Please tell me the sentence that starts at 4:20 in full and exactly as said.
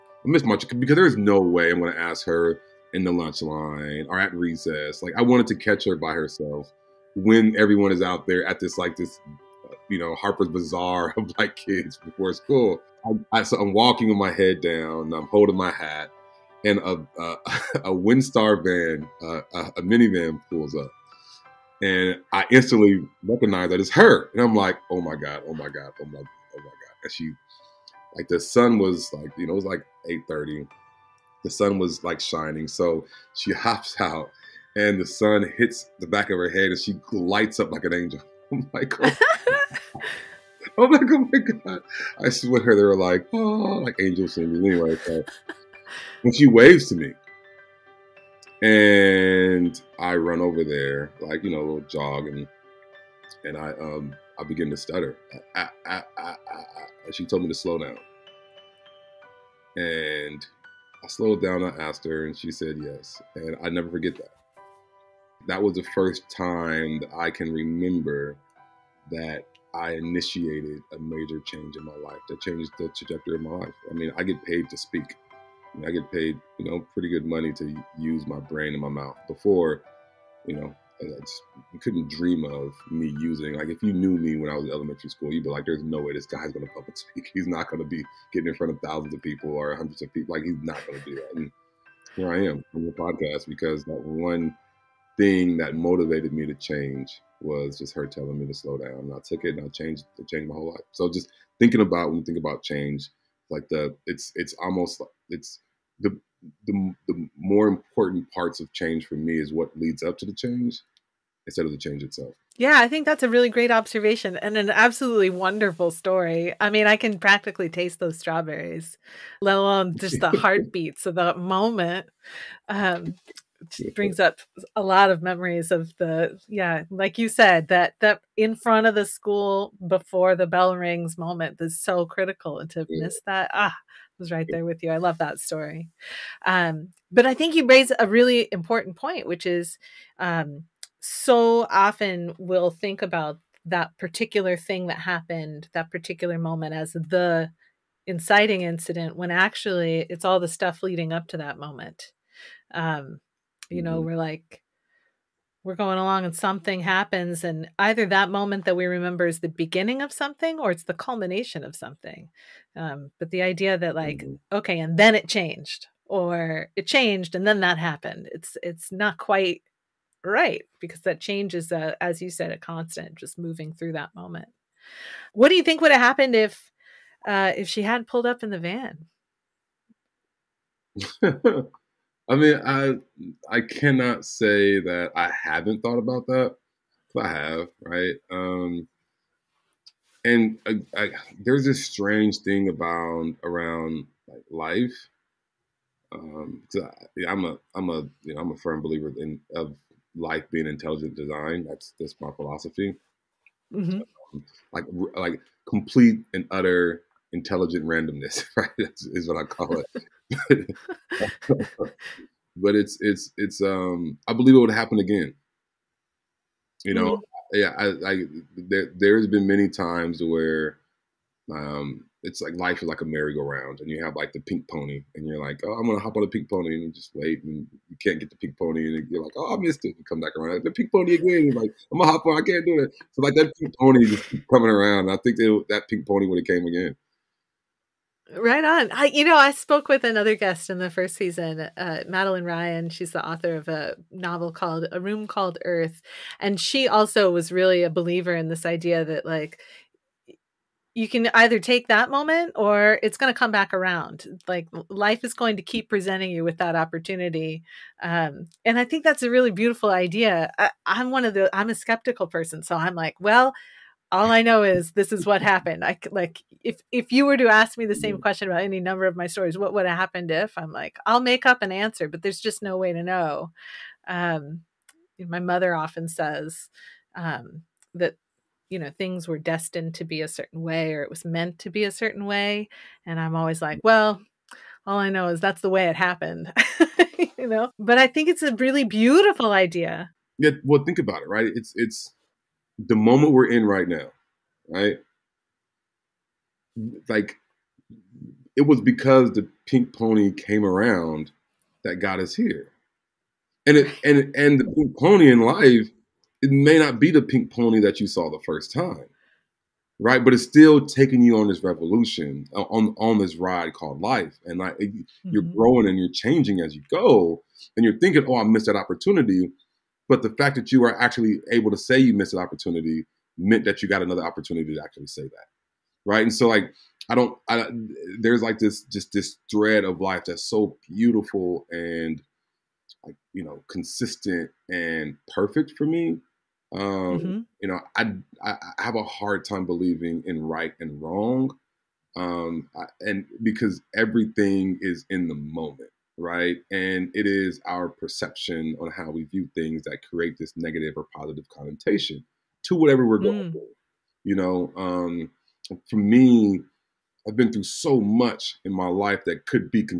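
I, I'm one of the, I'm a skeptical person.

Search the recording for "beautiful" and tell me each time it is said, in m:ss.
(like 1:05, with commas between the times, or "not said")
4:19, 4:48, 5:30.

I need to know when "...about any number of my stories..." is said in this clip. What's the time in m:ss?
4:28.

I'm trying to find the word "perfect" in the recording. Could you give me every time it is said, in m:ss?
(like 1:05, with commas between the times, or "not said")
5:35.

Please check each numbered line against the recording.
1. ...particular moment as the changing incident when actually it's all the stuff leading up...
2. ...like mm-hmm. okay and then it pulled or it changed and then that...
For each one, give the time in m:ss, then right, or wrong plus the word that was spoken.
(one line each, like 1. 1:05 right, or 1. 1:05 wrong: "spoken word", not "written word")
1. 2:25 wrong: "inciting", not "changing"
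2. 2:43 wrong: "changed", not "pulled".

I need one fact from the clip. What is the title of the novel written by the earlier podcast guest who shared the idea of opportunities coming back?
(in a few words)
A Room Called Earth.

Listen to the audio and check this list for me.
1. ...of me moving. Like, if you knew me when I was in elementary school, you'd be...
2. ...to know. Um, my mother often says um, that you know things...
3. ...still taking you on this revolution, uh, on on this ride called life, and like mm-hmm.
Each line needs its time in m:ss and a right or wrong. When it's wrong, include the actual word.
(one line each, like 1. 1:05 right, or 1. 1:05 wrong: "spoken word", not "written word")
1. 1:22 wrong: "using", not "moving"
2. 4:32 right
3. 5:10 right.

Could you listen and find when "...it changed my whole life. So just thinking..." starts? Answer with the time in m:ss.
1:40.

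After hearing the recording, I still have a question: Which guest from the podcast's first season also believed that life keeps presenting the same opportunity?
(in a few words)
Madeleine Ryan.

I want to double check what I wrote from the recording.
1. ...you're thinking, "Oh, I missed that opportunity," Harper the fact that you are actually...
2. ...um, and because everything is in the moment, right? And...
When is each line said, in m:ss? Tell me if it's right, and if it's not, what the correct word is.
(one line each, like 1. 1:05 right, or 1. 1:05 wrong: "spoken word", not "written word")
1. 5:17 wrong: "But", not "Harper"
2. 5:42 right.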